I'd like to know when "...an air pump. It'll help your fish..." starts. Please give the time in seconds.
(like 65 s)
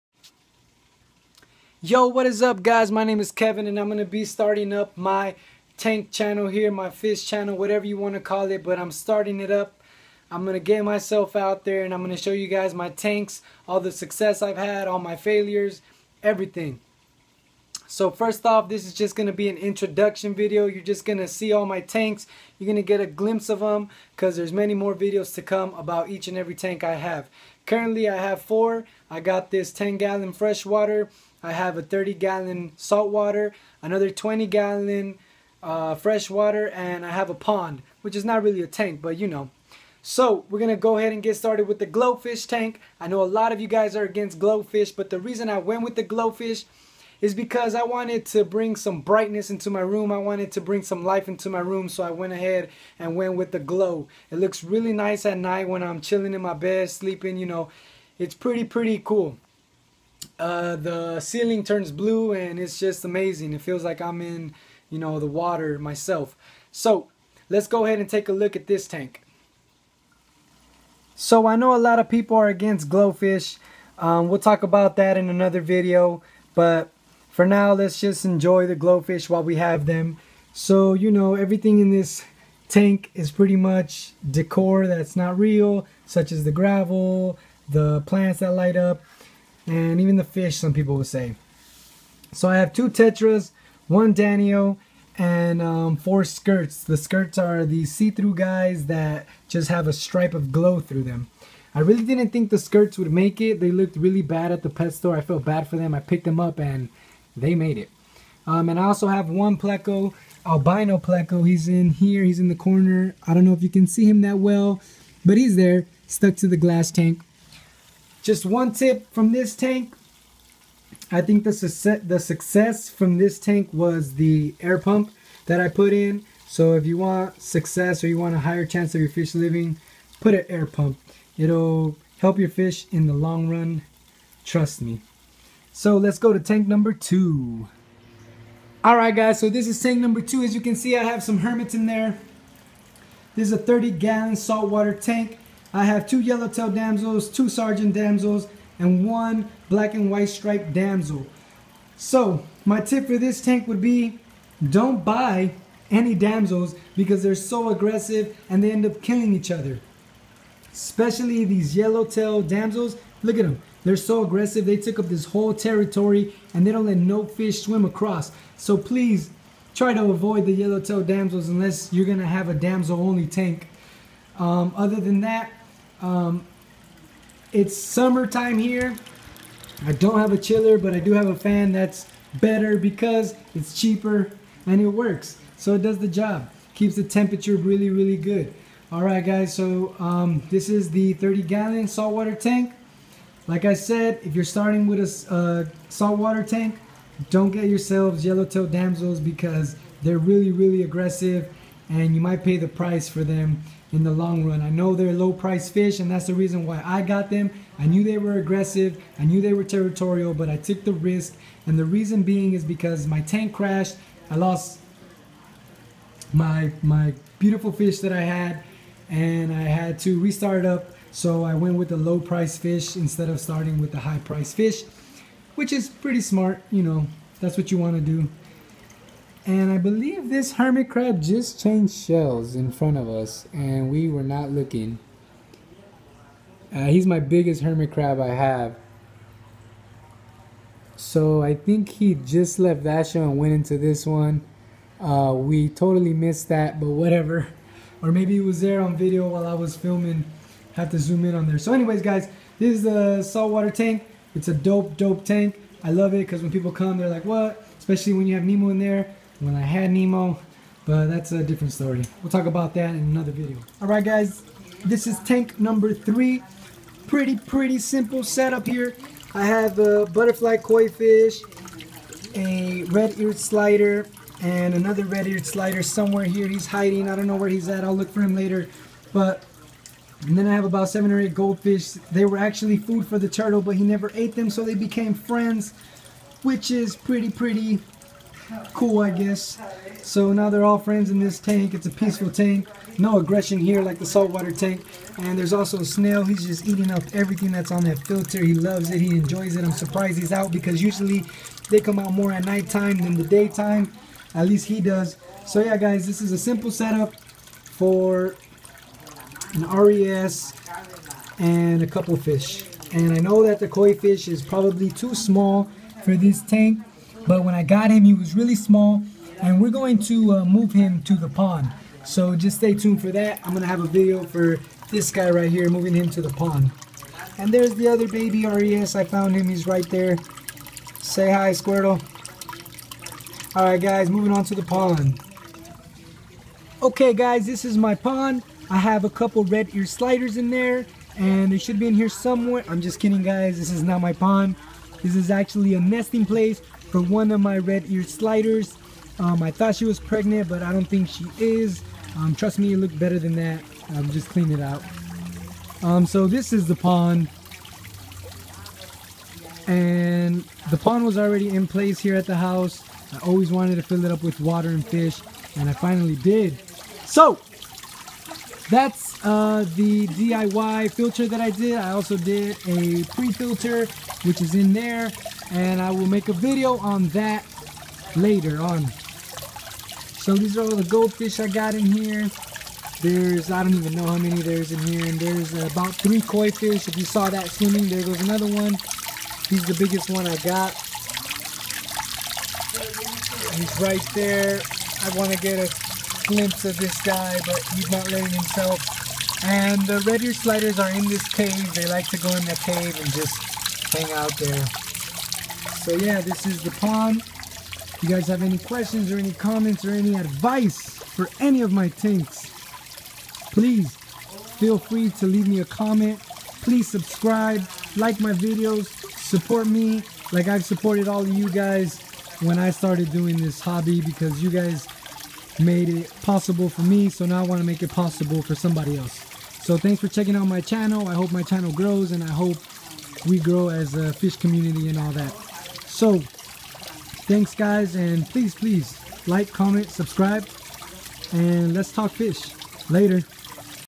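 130 s.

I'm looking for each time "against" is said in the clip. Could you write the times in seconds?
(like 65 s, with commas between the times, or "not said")
44 s, 72 s.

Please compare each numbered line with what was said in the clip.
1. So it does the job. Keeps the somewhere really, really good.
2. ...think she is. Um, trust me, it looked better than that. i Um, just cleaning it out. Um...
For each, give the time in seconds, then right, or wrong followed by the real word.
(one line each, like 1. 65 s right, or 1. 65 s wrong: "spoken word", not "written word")
1. 185 s wrong: "temperature", not "somewhere"
2. 350 s right.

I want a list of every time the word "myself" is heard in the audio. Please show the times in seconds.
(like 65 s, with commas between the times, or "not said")
10 s, 65 s.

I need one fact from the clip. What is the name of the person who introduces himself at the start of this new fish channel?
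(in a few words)
Kevin.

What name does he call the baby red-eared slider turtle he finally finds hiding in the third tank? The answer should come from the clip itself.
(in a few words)
Squirtle.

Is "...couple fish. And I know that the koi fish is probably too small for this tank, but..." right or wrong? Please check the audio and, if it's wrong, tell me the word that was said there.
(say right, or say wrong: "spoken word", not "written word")
right.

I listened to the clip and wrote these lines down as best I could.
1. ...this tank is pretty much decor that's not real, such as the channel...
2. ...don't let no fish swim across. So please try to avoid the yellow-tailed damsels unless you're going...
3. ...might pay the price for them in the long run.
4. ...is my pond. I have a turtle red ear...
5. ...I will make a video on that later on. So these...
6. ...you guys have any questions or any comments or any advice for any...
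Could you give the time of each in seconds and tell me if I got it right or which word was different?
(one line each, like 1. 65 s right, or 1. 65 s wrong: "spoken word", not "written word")
1. 81 s wrong: "gravel", not "channel"
2. 166 s right
3. 202 s right
4. 337 s wrong: "couple", not "turtle"
5. 375 s right
6. 408 s right.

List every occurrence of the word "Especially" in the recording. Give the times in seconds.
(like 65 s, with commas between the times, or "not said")
160 s, 257 s.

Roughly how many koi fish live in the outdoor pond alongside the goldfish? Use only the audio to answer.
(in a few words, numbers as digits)
3.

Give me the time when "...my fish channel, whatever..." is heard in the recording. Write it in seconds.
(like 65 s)
6 s.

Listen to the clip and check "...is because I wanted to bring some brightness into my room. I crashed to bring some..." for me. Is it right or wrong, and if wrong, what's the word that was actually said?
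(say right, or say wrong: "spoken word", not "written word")
wrong: "wanted", not "crashed".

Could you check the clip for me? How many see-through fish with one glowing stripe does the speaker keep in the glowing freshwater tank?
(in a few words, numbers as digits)
4.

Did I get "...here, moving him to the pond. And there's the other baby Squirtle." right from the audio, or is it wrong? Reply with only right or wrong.
wrong.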